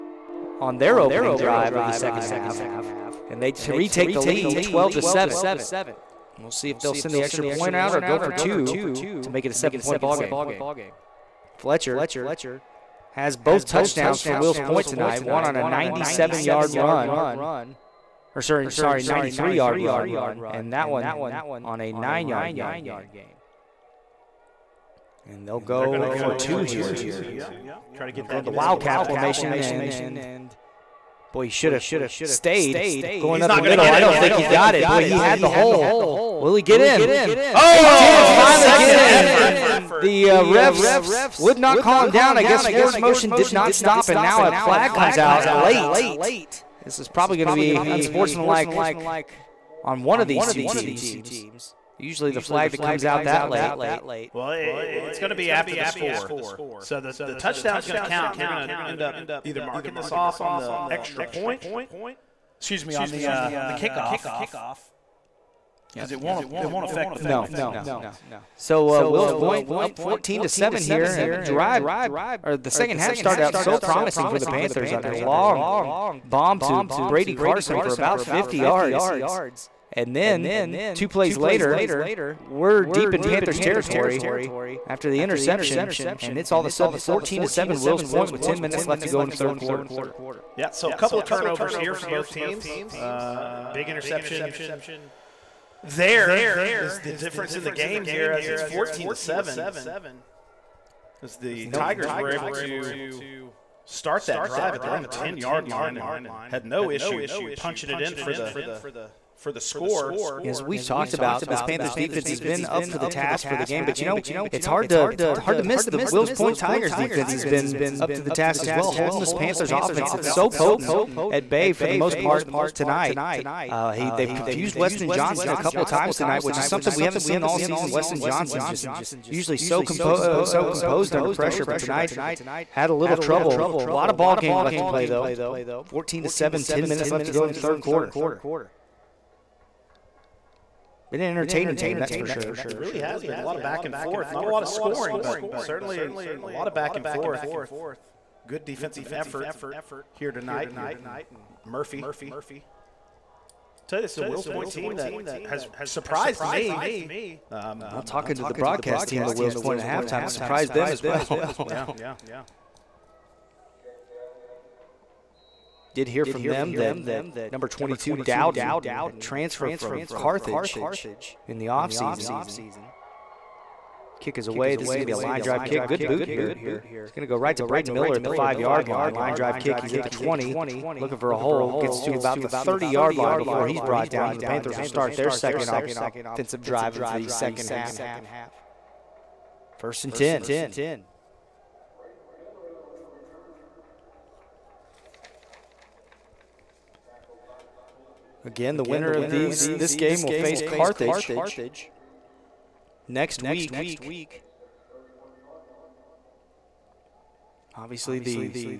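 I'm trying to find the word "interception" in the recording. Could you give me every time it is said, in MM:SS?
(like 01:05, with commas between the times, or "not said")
01:25, 01:33.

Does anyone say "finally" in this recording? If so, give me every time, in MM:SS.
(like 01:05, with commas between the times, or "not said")
00:38.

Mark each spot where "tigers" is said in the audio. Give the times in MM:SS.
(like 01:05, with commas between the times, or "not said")
01:41, 01:56.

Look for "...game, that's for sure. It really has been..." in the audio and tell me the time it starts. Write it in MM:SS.
02:21.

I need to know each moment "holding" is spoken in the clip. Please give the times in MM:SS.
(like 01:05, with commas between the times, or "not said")
01:58.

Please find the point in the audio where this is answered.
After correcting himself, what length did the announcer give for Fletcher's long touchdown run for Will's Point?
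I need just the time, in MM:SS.
00:19.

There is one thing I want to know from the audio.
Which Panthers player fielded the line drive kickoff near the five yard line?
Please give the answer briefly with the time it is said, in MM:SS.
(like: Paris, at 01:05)
Braden Miller, at 02:57.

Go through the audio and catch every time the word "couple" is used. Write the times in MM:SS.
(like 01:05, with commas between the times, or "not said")
01:30, 02:05.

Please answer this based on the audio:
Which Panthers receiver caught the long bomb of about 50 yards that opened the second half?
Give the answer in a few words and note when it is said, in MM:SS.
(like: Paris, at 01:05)
Brady Carson, at 01:16.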